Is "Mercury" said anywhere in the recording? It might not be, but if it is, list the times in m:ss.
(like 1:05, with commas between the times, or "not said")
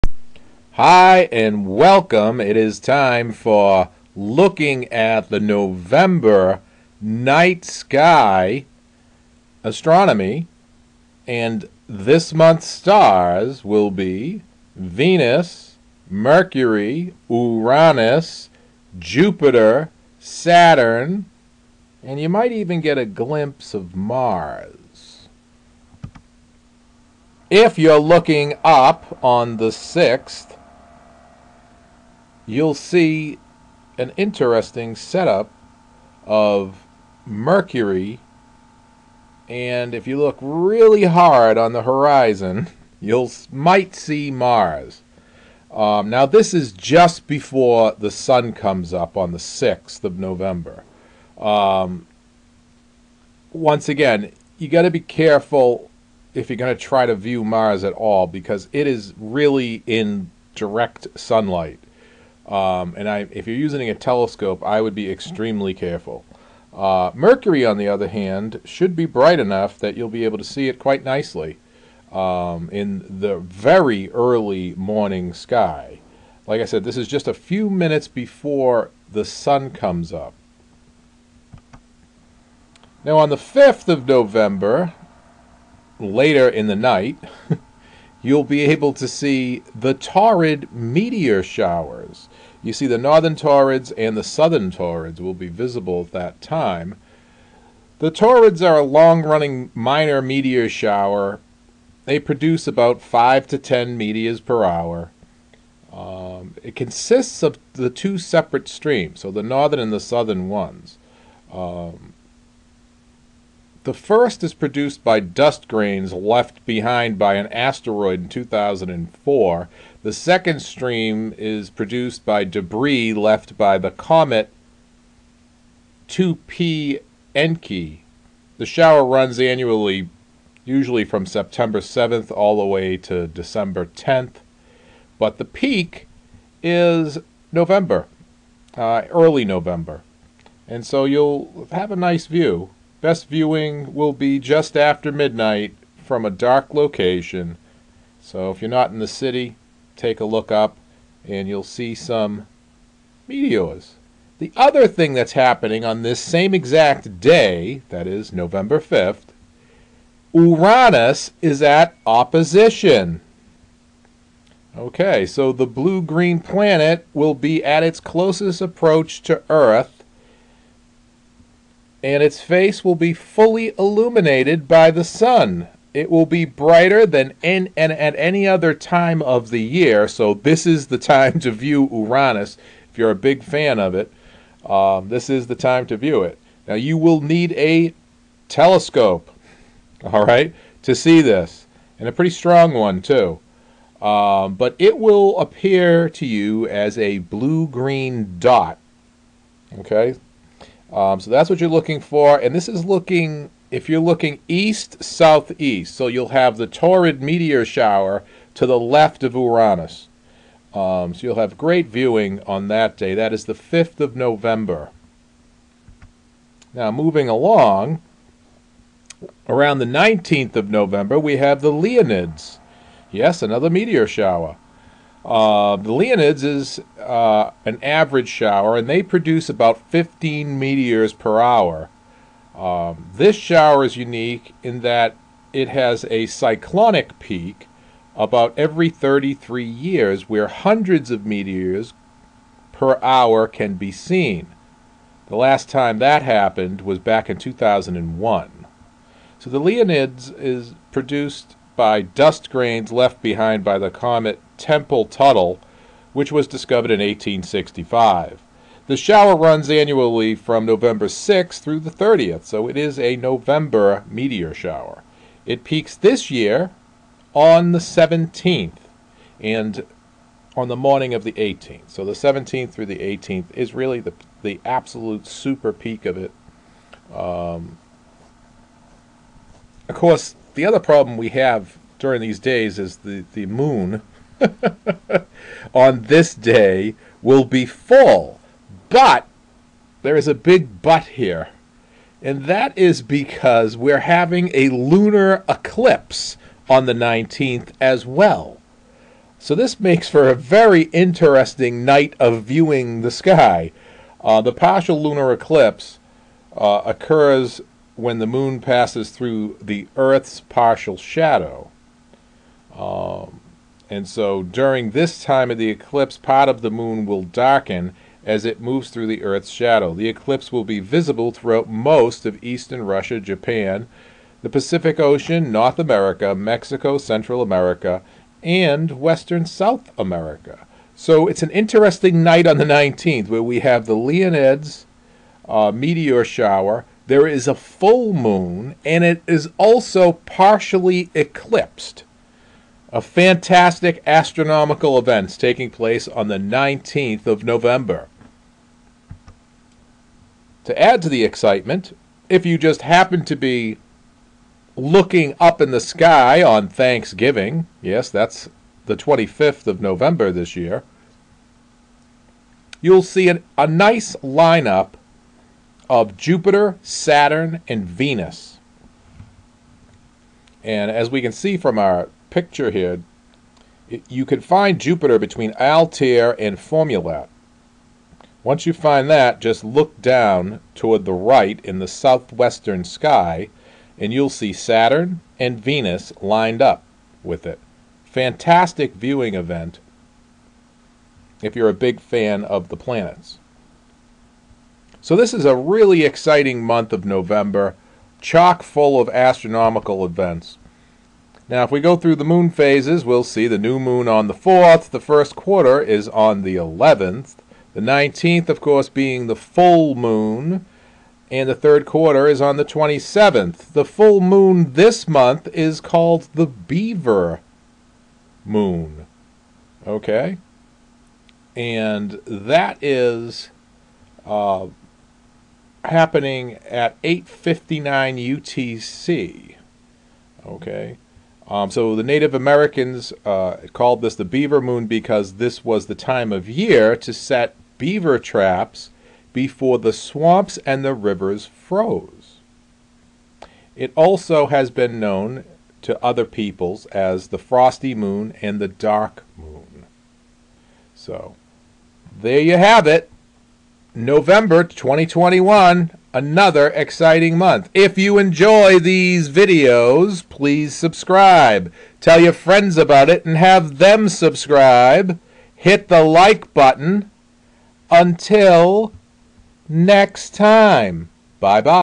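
0:16, 0:37, 1:07.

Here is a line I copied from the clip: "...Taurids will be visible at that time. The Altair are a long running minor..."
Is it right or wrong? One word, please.
wrong.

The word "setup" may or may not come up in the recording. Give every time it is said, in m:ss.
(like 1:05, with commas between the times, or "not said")
0:34.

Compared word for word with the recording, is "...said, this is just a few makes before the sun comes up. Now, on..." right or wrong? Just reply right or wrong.
wrong.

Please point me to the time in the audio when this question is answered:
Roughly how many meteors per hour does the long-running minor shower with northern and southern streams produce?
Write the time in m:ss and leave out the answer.
1:43.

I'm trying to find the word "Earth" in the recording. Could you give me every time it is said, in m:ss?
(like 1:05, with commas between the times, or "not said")
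2:49, 5:09, 5:19.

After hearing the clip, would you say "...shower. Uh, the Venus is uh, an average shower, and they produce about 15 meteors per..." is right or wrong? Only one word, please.
wrong.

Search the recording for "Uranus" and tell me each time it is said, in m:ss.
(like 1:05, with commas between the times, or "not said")
0:17, 2:40, 3:01, 3:29.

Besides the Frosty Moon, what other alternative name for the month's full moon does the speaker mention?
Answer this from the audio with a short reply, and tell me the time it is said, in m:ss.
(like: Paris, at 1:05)
Dark Moon, at 7:28.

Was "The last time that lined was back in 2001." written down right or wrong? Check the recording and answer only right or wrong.
wrong.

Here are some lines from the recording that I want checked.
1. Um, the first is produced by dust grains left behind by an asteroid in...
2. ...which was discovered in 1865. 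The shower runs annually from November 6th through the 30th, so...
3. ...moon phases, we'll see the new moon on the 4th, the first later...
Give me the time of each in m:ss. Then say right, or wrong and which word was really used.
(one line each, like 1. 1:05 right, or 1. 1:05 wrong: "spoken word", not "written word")
1. 1:51 right
2. 4:16 right
3. 6:42 wrong: "quarter", not "later".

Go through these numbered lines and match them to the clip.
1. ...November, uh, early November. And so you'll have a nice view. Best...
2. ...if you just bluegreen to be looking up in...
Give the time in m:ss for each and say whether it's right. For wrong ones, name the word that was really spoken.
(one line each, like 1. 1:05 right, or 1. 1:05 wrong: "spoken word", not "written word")
1. 2:17 right
2. 5:52 wrong: "happen", not "bluegreen".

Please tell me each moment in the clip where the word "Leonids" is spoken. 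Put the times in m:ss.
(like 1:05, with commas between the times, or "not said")
3:41, 3:45, 4:09, 5:33.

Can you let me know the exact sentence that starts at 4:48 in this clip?
But there is a big but here.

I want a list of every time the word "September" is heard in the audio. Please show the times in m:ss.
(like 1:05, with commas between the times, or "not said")
2:11.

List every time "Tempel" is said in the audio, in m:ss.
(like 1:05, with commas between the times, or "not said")
4:14.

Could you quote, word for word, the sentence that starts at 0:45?
Um, now, this is just before the sun comes up on the 6th of November.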